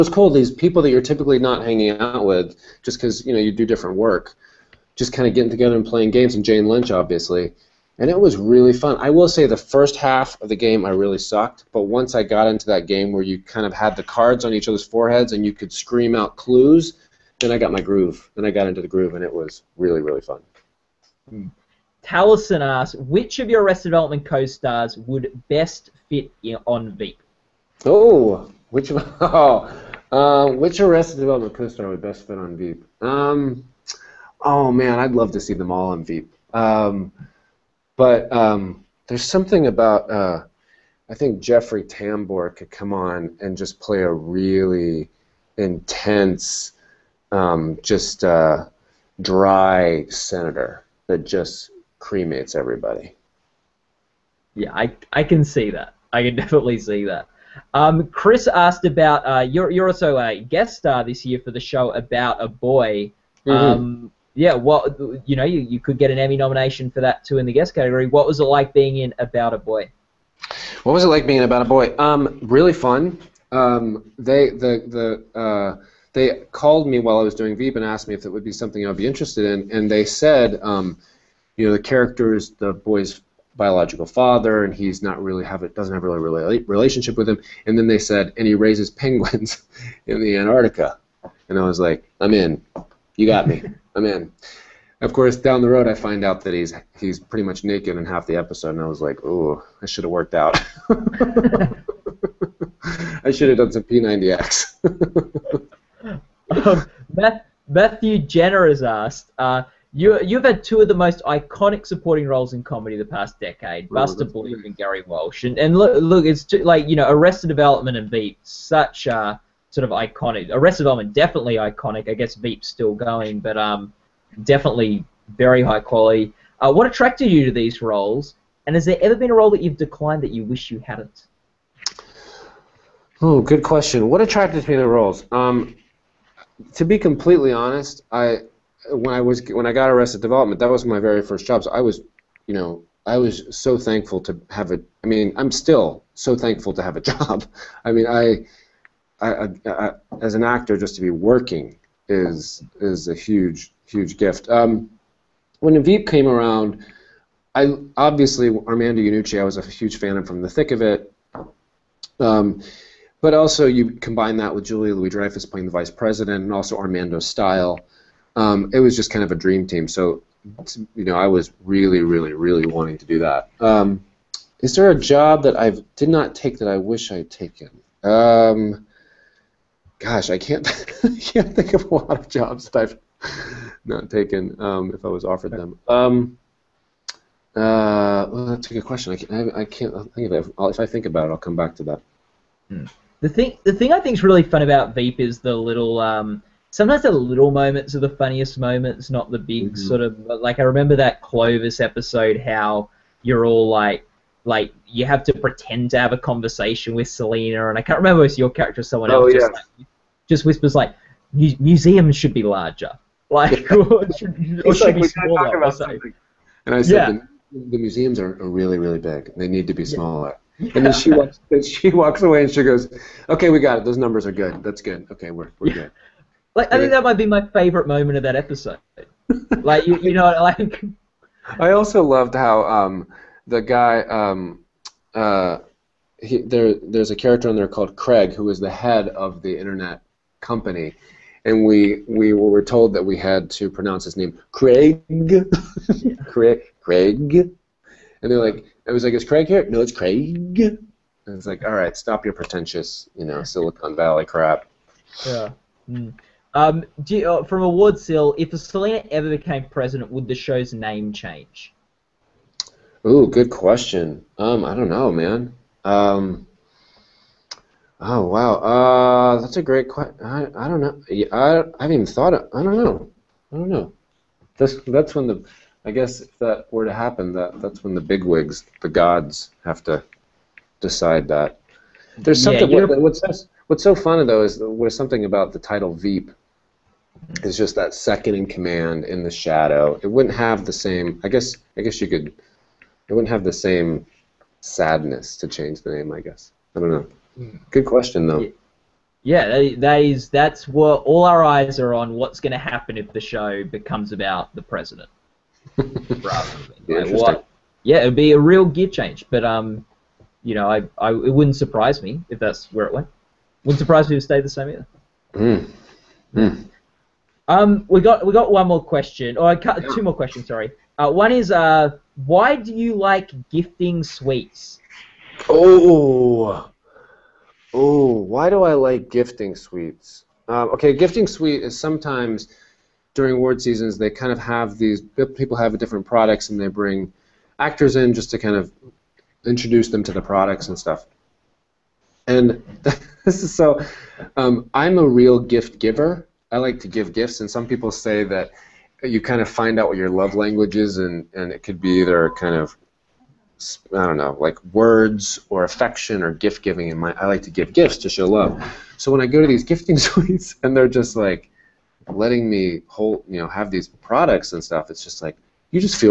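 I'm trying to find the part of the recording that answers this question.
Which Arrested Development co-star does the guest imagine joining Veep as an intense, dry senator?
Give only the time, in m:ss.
0:41.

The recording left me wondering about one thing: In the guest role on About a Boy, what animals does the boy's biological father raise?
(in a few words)
penguins.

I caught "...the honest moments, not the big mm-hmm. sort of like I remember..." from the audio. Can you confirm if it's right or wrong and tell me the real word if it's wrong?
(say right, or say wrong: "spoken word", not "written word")
wrong: "funniest", not "honest".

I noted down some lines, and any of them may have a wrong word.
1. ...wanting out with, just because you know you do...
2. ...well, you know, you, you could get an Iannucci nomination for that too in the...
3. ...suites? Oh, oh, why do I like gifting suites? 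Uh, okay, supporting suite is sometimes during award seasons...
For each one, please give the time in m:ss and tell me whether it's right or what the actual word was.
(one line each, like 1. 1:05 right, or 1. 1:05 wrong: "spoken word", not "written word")
1. 0:01 wrong: "hanging", not "wanting"
2. 1:04 wrong: "Emmy", not "Iannucci"
3. 5:24 wrong: "gifting", not "supporting".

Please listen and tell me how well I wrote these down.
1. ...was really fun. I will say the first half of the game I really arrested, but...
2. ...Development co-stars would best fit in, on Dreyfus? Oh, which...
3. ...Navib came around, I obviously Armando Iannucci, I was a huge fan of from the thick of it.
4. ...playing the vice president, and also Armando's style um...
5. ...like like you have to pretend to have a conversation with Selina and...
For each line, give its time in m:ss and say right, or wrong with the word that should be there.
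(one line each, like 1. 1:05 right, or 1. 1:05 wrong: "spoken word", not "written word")
1. 0:08 wrong: "sucked", not "arrested"
2. 0:23 wrong: "Veep", not "Dreyfus"
3. 2:35 right
4. 2:45 right
5. 3:23 right.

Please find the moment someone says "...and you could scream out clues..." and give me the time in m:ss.
0:15.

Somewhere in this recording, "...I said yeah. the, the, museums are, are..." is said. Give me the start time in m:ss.
3:36.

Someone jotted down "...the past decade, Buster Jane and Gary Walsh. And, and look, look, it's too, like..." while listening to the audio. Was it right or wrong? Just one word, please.
wrong.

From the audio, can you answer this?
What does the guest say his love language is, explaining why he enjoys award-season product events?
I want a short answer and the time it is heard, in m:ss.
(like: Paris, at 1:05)
gift giving, at 5:56.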